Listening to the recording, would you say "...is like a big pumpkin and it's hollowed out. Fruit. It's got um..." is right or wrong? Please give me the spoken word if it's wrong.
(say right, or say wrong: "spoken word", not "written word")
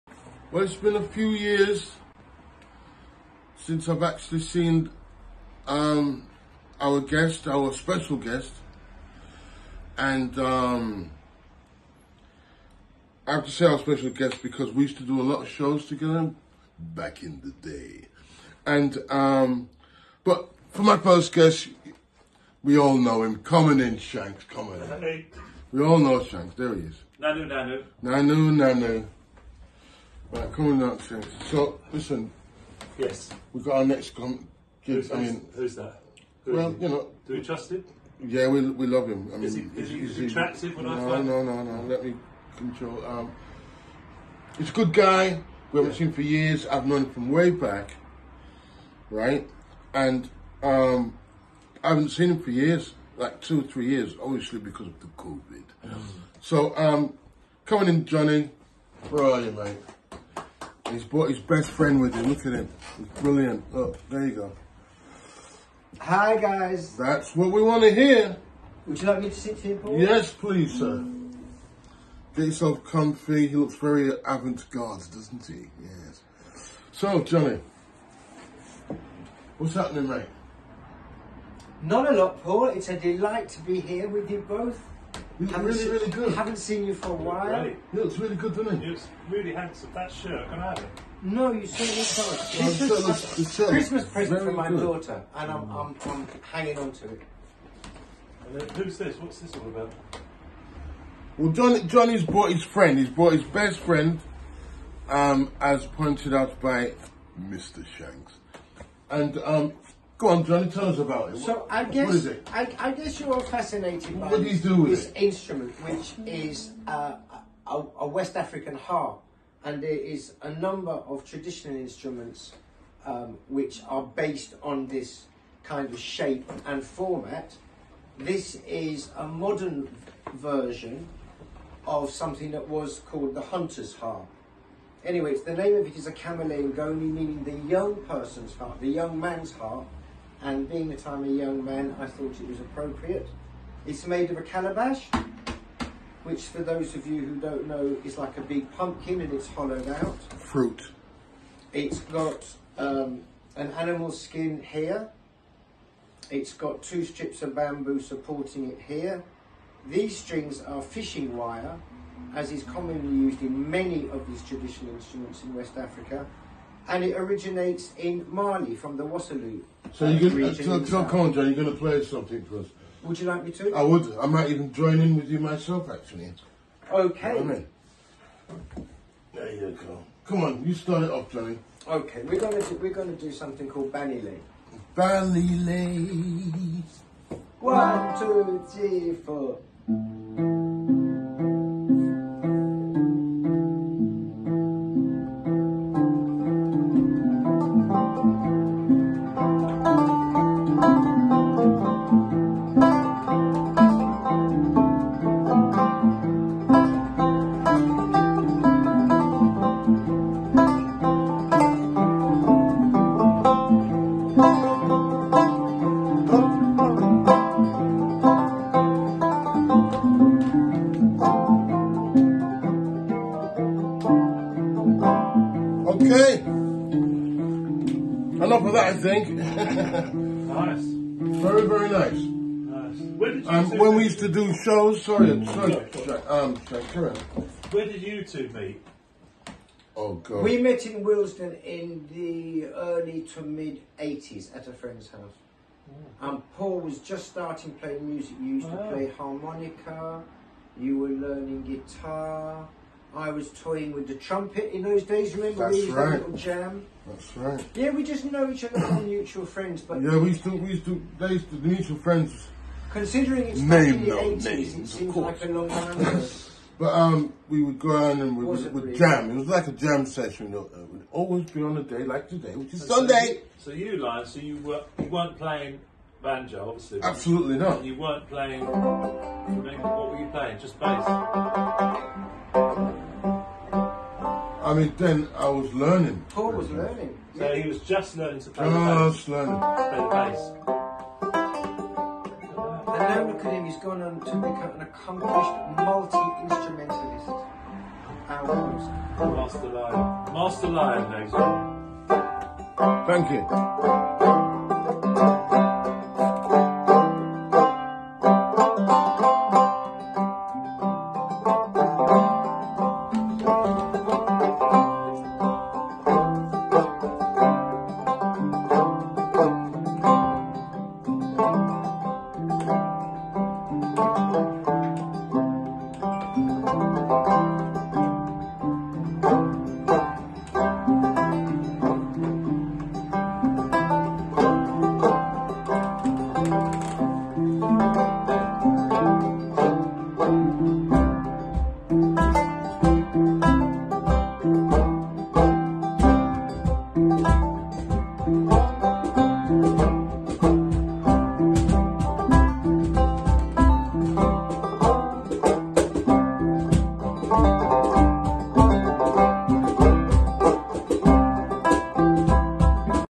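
right.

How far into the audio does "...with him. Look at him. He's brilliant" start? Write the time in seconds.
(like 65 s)
62 s.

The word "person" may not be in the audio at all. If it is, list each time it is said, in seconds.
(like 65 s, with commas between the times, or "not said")
138 s.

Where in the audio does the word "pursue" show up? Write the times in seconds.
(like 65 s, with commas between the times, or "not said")
not said.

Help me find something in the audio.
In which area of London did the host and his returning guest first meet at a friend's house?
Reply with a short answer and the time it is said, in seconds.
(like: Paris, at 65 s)
Willesden, at 241 s.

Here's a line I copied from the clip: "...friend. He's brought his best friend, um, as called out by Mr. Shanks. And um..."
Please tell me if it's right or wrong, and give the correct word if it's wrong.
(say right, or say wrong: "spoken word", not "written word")
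wrong: "pointed", not "called".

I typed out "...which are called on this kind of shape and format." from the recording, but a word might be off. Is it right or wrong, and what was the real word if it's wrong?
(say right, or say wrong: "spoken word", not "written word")
wrong: "based", not "called".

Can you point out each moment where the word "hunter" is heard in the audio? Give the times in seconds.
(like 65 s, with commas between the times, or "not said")
133 s.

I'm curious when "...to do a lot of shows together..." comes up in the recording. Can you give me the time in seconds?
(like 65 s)
14 s.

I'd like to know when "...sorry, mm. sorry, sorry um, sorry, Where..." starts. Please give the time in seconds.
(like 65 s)
235 s.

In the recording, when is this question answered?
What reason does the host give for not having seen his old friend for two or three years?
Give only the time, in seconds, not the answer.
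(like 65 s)
55 s.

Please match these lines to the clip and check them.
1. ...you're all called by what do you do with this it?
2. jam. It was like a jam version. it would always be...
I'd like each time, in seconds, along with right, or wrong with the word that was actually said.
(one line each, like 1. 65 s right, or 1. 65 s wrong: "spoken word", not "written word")
1. 113 s wrong: "fascinated", not "called"
2. 268 s wrong: "session", not "version".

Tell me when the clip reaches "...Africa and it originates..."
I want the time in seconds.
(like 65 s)
165 s.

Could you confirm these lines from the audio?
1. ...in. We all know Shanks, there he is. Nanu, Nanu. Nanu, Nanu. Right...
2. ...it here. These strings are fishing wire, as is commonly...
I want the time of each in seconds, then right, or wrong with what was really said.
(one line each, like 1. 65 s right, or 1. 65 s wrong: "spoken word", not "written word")
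1. 24 s right
2. 158 s right.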